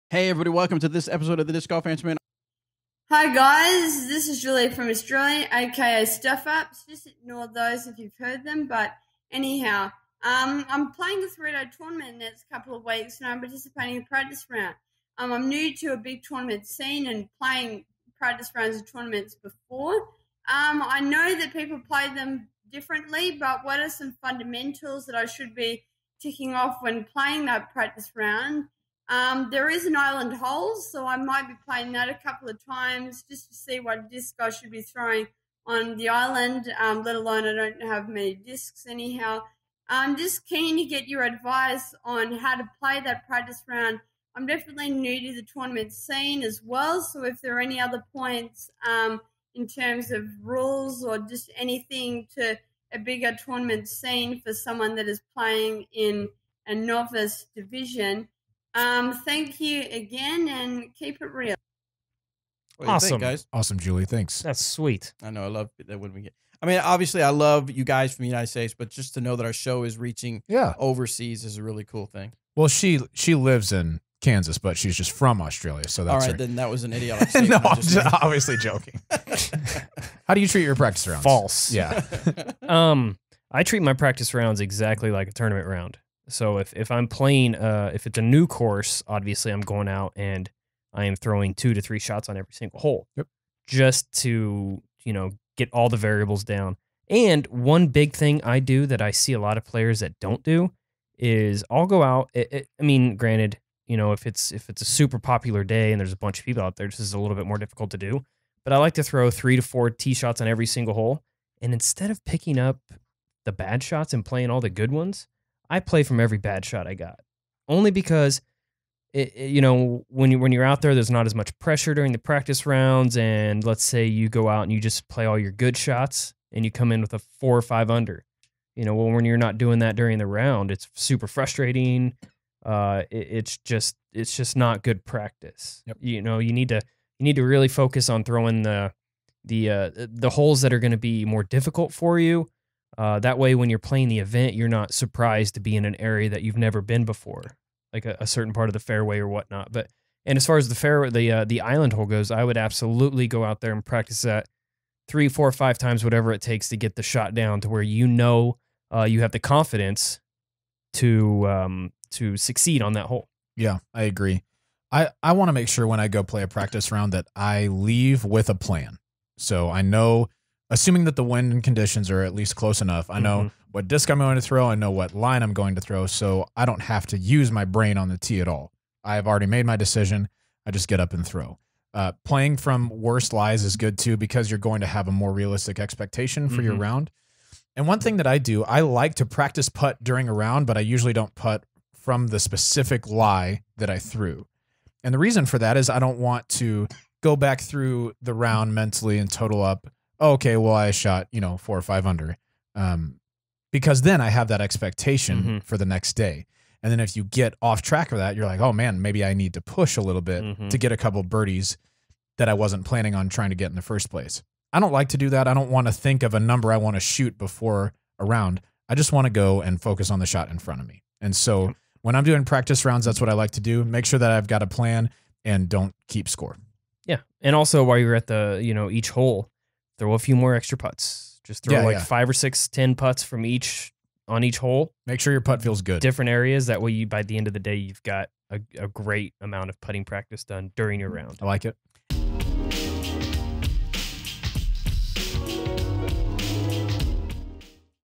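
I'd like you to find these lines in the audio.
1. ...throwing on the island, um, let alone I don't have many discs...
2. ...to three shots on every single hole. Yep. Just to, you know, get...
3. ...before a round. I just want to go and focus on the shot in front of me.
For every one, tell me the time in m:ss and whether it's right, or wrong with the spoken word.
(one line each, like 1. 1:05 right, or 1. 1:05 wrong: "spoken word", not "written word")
1. 0:34 right
2. 1:31 right
3. 3:37 right.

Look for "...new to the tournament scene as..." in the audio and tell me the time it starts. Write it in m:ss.
0:44.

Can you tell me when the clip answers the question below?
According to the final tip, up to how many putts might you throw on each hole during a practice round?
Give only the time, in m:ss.
3:52.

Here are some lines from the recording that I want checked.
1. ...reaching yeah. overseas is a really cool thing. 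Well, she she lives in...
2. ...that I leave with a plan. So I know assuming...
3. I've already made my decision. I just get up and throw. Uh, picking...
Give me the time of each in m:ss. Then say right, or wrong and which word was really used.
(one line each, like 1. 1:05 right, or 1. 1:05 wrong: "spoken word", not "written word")
1. 1:09 right
2. 2:47 right
3. 2:59 wrong: "playing", not "picking".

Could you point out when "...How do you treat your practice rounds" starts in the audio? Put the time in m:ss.
1:20.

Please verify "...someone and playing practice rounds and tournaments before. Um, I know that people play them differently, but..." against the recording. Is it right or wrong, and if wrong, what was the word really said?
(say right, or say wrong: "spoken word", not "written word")
wrong: "scene", not "someone".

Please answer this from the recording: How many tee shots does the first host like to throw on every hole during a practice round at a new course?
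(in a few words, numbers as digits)
3 to 4.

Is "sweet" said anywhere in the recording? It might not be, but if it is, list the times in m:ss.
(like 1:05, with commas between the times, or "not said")
1:04.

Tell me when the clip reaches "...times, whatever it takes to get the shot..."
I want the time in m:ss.
2:35.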